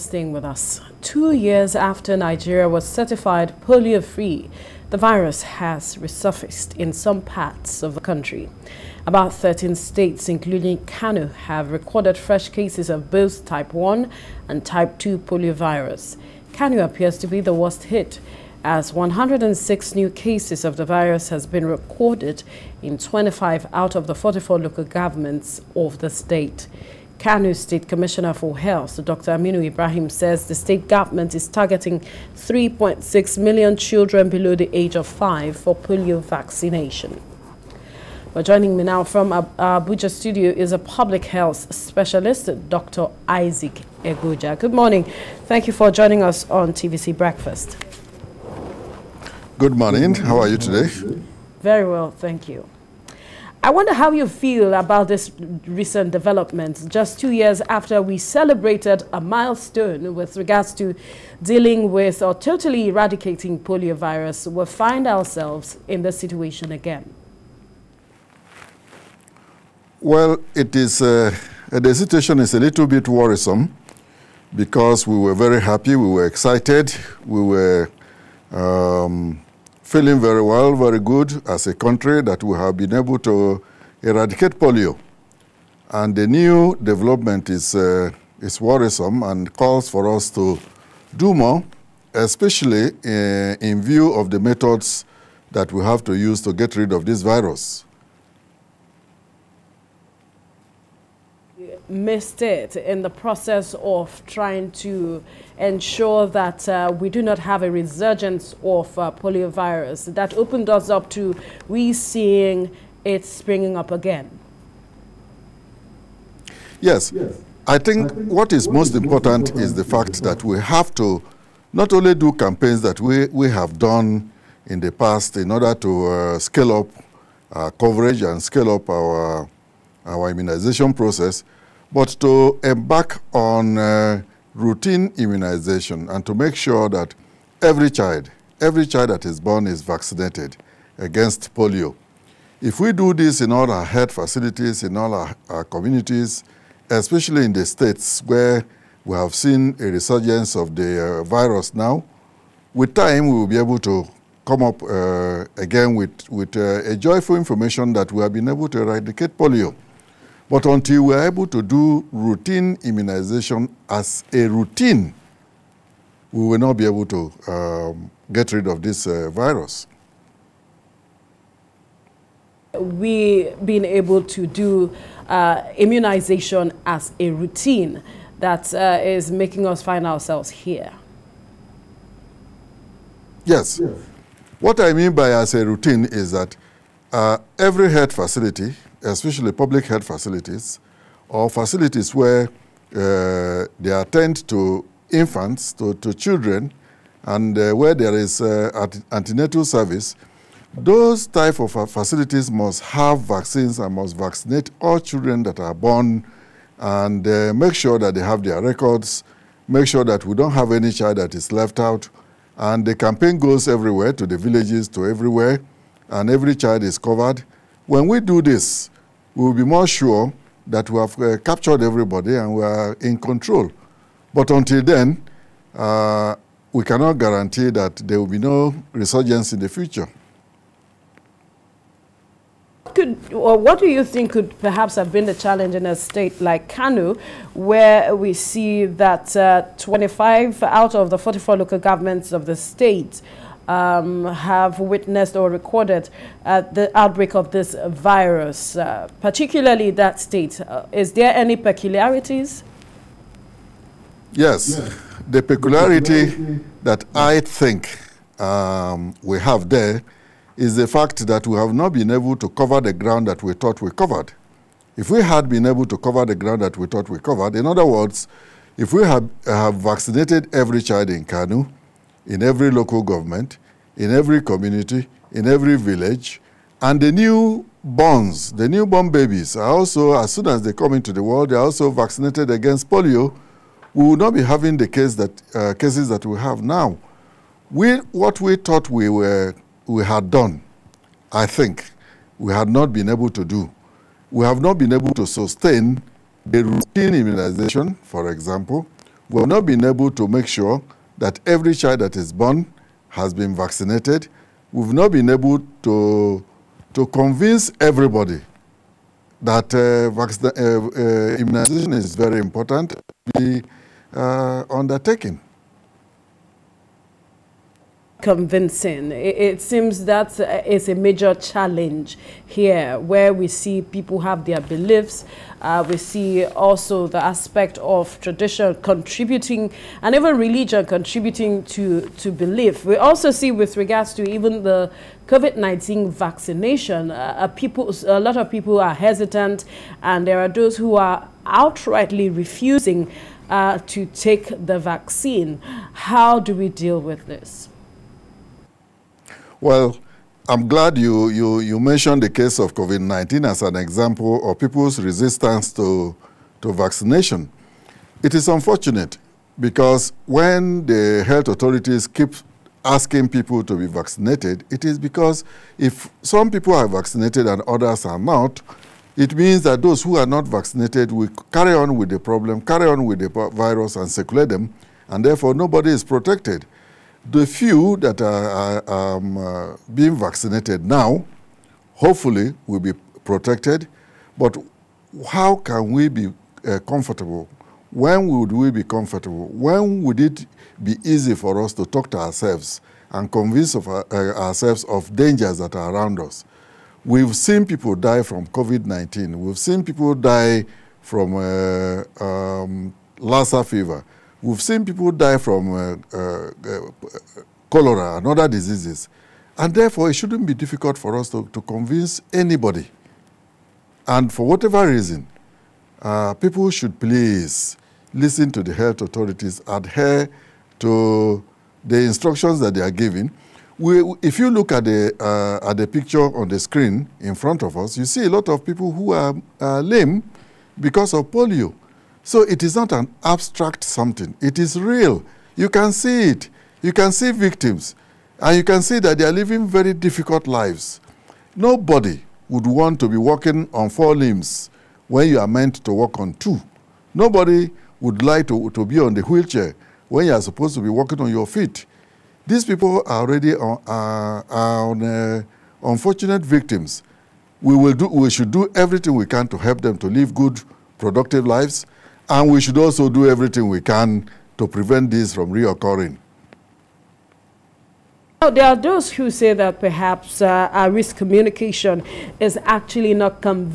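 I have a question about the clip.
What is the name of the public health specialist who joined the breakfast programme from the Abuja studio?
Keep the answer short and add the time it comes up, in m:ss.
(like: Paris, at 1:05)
Isaac Eguja, at 0:42.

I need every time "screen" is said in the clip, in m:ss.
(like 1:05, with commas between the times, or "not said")
7:06.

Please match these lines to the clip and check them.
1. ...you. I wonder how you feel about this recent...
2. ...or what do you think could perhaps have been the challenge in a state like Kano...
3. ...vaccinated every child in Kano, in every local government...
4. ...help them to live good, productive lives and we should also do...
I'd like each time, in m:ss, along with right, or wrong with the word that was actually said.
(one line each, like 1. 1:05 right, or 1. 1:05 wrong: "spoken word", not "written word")
1. 0:52 right
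2. 3:53 right
3. 4:29 right
4. 7:39 right.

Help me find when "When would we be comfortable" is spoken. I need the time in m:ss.
6:27.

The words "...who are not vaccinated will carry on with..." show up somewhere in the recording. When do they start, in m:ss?
6:10.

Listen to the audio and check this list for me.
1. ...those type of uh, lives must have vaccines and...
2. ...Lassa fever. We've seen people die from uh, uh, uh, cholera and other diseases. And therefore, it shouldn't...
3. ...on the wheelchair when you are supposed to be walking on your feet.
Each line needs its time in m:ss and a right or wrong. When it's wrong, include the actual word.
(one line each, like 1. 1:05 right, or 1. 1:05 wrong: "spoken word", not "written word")
1. 3:20 wrong: "facilities", not "lives"
2. 6:43 right
3. 7:28 right.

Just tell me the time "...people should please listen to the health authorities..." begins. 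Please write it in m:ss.
6:56.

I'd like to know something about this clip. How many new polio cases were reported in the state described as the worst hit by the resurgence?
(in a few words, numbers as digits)
106.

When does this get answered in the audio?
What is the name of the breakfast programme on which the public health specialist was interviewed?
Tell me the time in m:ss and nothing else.
0:46.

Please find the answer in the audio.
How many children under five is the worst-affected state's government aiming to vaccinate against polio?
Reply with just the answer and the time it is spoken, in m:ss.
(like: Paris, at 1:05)
3.6 million, at 0:32.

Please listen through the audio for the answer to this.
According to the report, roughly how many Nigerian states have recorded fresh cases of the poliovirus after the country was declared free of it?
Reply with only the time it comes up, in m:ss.
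0:09.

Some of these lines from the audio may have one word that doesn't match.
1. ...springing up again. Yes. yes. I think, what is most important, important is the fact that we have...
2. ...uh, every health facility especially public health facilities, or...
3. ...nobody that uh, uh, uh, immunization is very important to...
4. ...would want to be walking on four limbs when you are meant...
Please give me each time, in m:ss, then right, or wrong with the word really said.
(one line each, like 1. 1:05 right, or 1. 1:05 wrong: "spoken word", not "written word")
1. 1:53 right
2. 3:07 right
3. 5:07 wrong: "everybody", not "nobody"
4. 7:22 right.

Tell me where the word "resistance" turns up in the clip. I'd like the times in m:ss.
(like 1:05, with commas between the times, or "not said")
5:55.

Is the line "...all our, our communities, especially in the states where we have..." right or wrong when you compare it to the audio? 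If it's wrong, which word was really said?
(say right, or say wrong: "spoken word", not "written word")
right.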